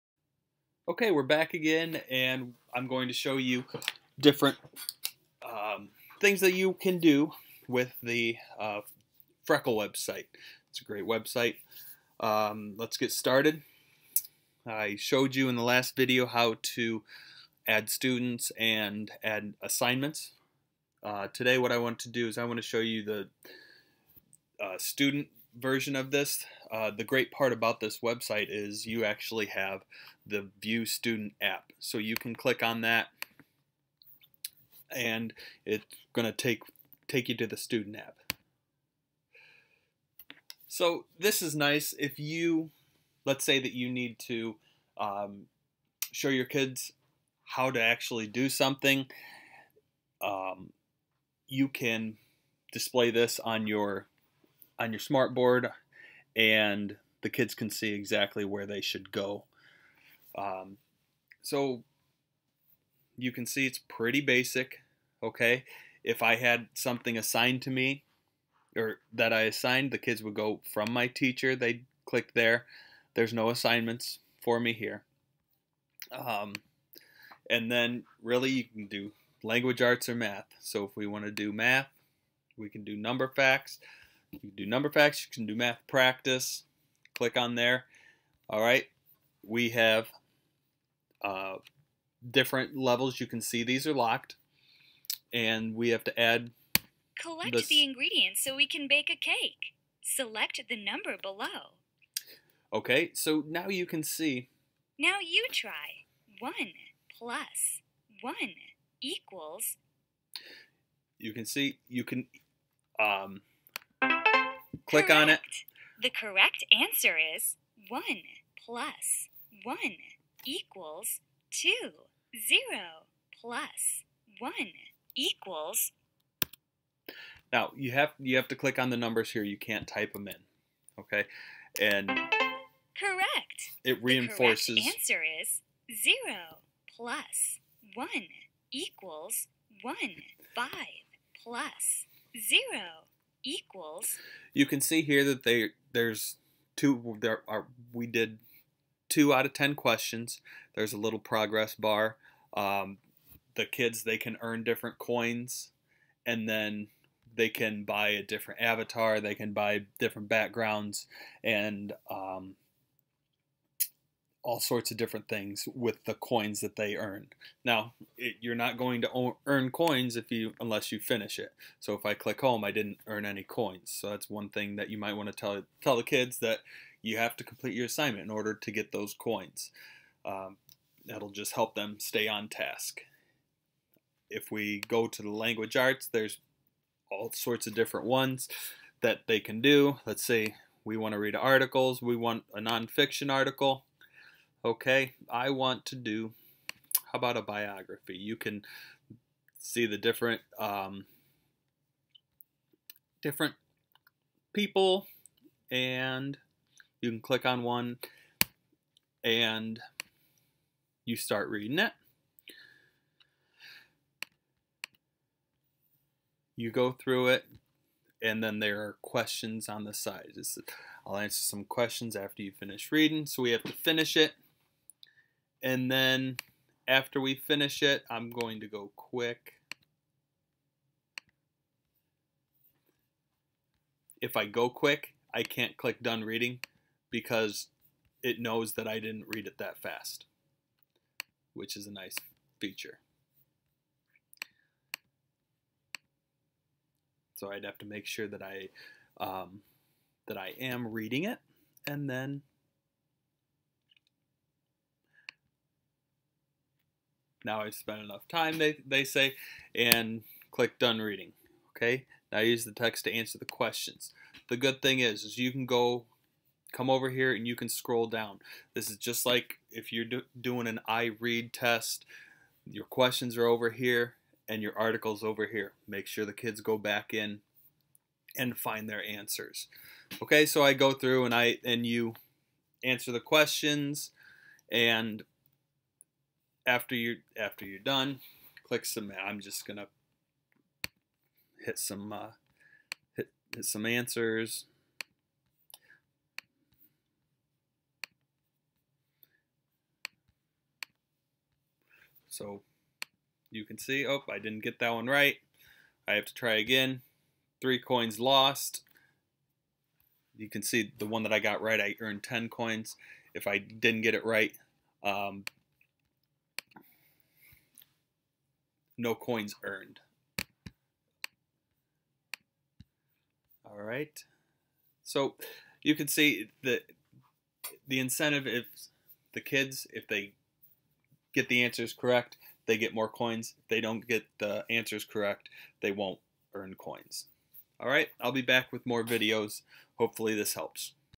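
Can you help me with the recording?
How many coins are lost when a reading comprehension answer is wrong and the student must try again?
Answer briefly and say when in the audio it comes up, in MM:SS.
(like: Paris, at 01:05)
3, at 05:07.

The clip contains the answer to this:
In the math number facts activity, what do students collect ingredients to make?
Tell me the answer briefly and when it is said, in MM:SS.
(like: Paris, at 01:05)
a cake, at 01:39.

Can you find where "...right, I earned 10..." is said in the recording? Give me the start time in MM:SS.
05:11.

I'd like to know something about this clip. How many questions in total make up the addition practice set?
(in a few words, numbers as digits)
10.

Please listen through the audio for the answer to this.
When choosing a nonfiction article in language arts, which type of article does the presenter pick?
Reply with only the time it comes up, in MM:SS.
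03:17.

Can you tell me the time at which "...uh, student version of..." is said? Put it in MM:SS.
00:24.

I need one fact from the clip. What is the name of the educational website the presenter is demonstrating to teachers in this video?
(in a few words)
Freckle.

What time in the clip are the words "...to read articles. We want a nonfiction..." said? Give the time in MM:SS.
03:11.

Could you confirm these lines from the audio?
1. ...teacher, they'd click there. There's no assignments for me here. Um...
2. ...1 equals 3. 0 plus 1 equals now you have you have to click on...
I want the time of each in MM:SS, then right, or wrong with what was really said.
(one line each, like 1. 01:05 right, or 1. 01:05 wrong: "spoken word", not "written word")
1. 01:11 right
2. 01:59 wrong: "2", not "3".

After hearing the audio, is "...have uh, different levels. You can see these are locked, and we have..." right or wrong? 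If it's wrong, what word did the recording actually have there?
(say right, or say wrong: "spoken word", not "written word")
right.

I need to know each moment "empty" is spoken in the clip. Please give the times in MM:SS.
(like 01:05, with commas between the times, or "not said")
not said.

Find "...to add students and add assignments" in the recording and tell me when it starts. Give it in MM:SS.
00:16.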